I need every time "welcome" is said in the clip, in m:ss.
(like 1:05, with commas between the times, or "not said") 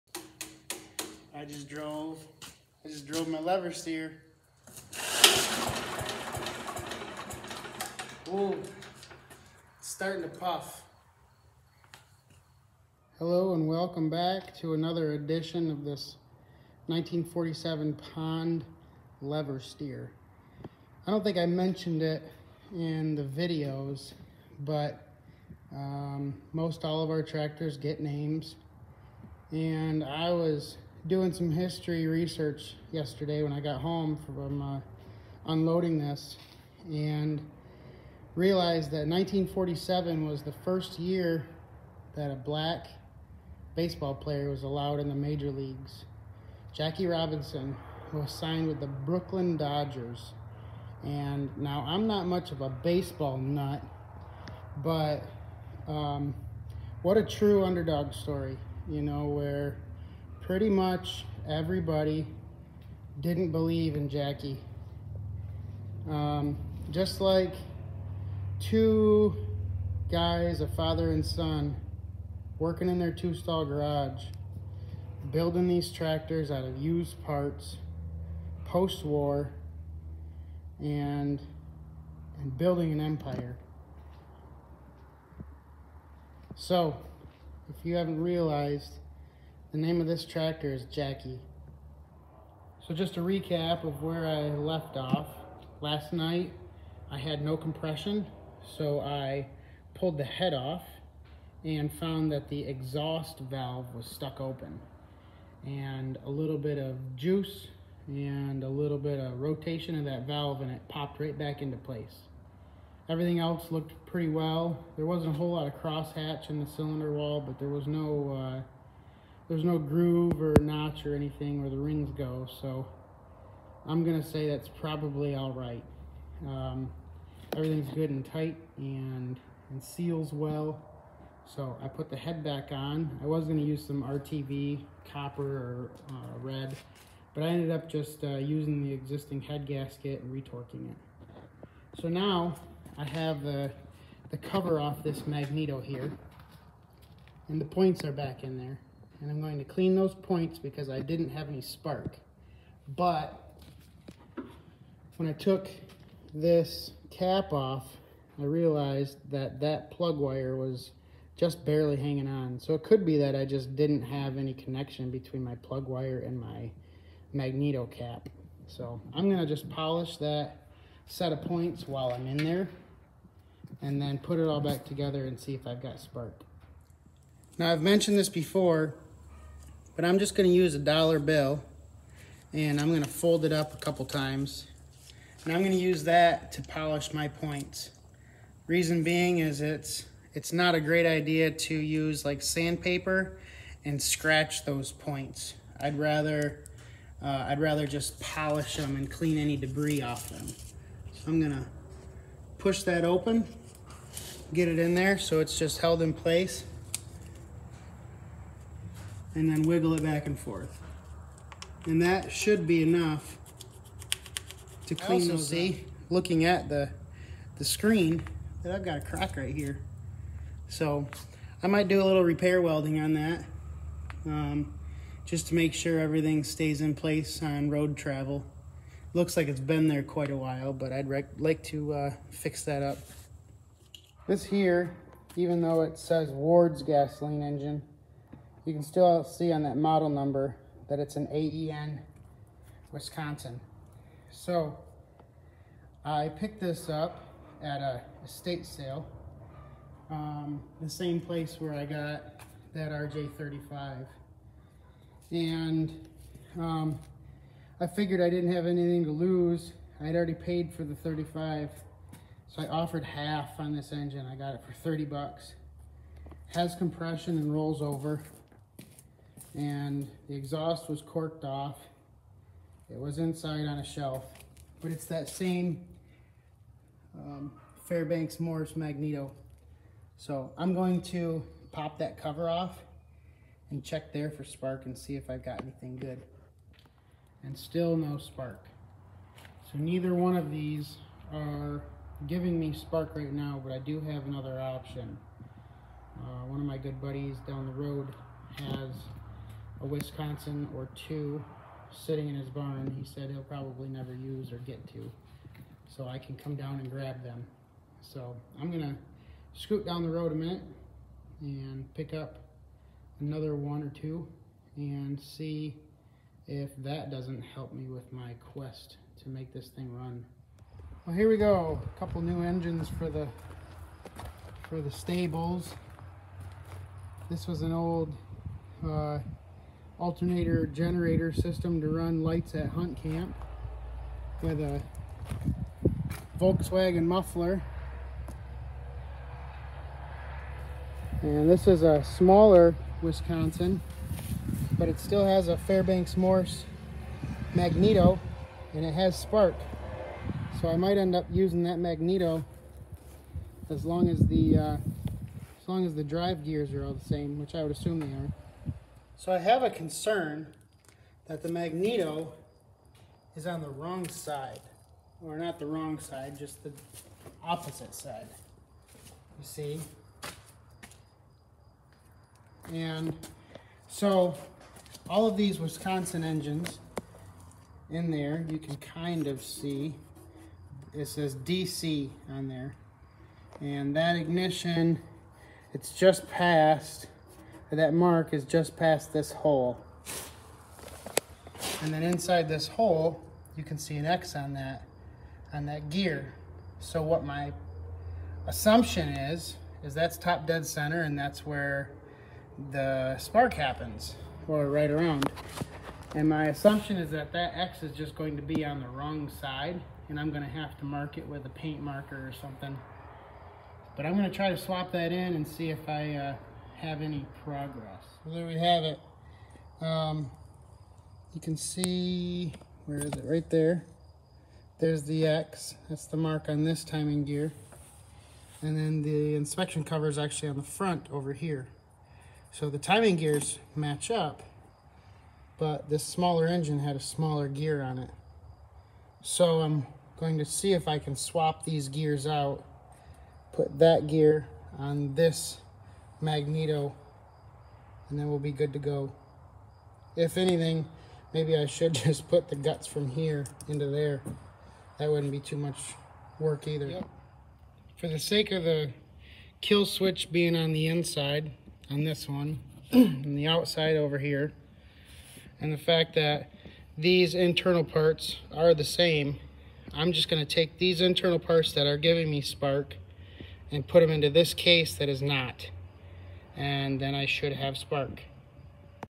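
0:13.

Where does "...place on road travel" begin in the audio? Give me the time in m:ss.
3:46.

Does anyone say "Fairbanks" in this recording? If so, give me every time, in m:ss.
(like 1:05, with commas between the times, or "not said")
4:37, 5:45.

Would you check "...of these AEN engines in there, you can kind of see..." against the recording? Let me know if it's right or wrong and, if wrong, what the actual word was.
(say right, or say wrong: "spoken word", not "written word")
wrong: "Wisconsin", not "AEN".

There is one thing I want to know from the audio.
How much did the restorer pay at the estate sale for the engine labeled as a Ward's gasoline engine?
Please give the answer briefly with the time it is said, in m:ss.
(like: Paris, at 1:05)
$30, at 4:24.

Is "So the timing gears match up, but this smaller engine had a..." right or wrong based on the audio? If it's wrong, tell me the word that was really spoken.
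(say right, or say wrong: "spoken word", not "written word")
right.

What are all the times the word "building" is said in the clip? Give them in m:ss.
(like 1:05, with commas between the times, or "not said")
1:15, 1:22.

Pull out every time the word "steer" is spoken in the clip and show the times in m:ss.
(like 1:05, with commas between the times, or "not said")
0:03, 0:19.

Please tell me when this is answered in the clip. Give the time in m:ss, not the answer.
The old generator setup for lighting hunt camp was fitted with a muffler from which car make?
5:36.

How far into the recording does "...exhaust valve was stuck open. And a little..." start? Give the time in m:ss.
1:42.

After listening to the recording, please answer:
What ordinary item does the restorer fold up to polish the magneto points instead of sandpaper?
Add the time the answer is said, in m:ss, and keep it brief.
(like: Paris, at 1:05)
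dollar bill, at 3:00.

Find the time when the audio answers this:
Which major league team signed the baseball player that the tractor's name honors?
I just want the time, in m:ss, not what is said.
0:48.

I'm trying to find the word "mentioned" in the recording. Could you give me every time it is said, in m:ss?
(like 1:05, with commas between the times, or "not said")
0:21, 2:57.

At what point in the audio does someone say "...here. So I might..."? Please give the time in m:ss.
3:39.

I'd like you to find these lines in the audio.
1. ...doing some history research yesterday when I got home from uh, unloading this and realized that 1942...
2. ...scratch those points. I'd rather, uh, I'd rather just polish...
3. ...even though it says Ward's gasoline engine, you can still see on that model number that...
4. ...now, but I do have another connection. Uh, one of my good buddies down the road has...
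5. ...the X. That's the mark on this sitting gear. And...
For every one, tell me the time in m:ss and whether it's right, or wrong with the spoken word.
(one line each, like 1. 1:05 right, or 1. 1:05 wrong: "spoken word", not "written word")
1. 0:31 wrong: "1947", not "1942"
2. 3:14 right
3. 3:55 right
4. 4:53 wrong: "option", not "connection"
5. 7:05 wrong: "timing", not "sitting".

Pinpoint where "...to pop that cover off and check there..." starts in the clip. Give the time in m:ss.
4:41.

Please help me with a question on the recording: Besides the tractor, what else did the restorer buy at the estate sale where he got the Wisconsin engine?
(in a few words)
RJ35.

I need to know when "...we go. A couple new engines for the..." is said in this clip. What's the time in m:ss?
5:21.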